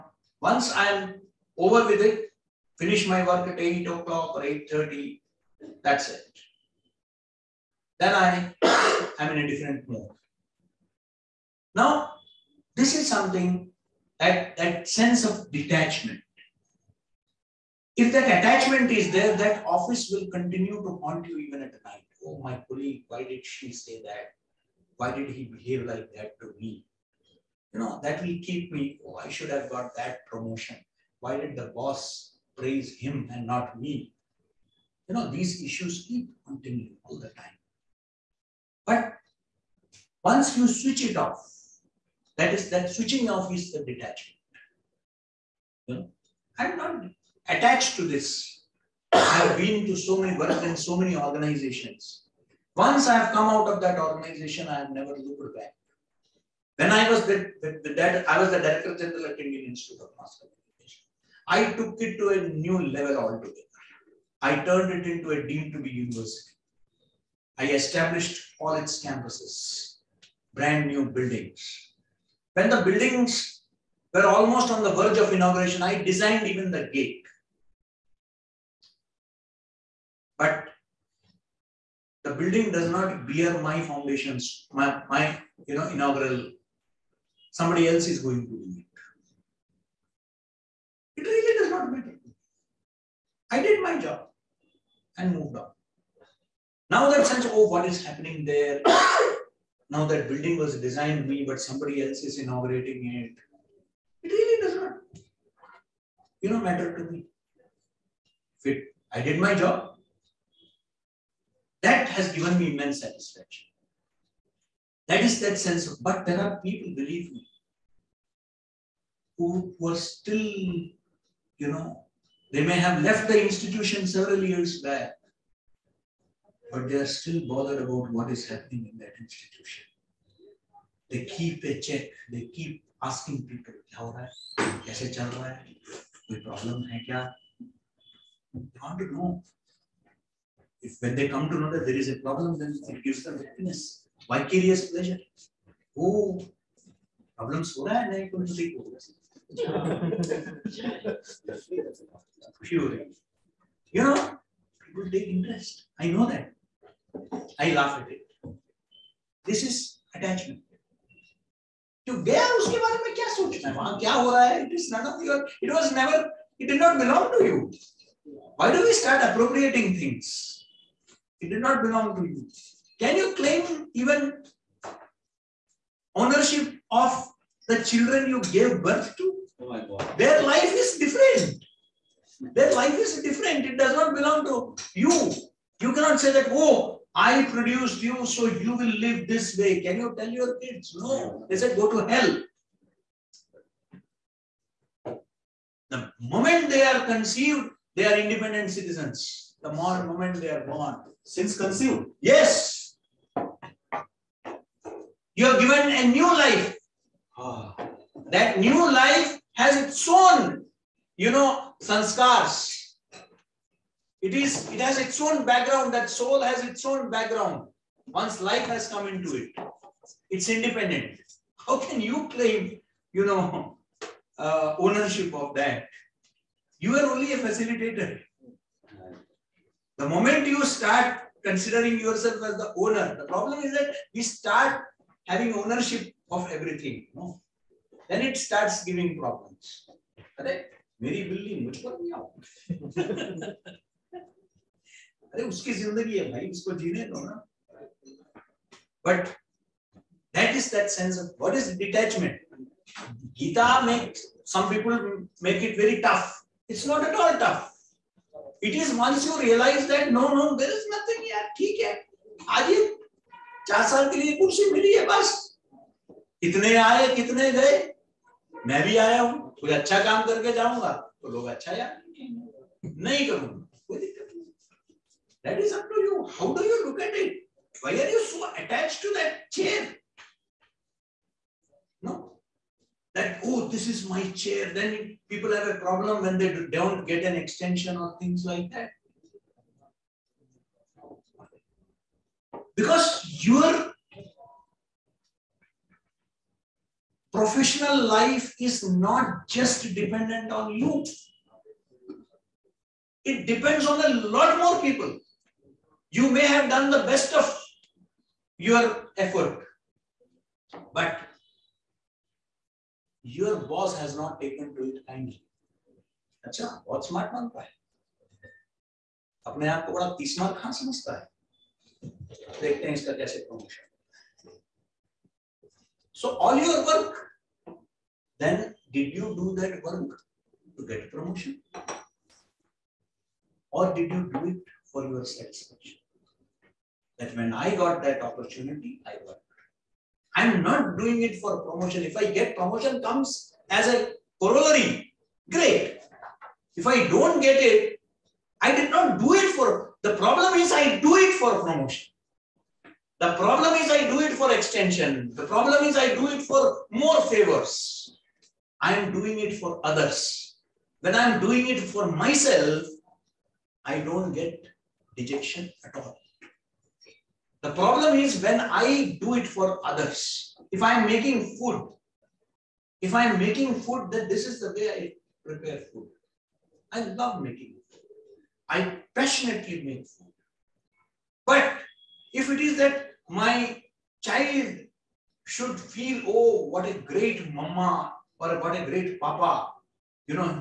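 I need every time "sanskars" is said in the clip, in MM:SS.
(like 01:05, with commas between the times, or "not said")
03:31.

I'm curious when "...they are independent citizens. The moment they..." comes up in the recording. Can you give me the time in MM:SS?
03:17.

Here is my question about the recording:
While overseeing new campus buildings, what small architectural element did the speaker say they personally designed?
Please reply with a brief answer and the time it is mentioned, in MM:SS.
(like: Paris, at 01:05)
the gate, at 01:16.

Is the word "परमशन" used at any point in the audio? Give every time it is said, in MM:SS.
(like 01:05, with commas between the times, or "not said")
05:23, 05:31.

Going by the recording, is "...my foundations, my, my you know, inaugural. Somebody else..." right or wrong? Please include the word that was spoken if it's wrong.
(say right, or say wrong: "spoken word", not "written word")
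right.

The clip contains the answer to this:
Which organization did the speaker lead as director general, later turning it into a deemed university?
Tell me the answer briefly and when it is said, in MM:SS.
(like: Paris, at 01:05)
Indian Institute of Mass Communication, at 00:59.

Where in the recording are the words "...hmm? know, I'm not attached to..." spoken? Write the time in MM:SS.
00:45.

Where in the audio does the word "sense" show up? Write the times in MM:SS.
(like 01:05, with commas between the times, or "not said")
00:14, 01:37, 01:55.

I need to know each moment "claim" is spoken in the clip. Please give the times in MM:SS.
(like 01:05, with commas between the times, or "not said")
02:53, 03:42.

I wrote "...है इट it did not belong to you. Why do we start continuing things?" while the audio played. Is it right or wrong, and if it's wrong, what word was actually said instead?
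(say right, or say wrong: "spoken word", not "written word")
wrong: "appropriating", not "continuing".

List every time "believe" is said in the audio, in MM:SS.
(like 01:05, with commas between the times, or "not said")
01:56.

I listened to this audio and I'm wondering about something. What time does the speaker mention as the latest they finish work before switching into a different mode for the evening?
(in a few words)
8.30.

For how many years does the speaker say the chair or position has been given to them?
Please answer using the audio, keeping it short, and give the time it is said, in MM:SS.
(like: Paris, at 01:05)
4, at 04:23.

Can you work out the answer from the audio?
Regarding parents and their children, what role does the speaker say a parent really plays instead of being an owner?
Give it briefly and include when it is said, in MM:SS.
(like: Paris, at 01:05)
facilitator, at 03:47.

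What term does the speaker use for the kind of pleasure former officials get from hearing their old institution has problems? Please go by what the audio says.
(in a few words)
vicarious pleasure.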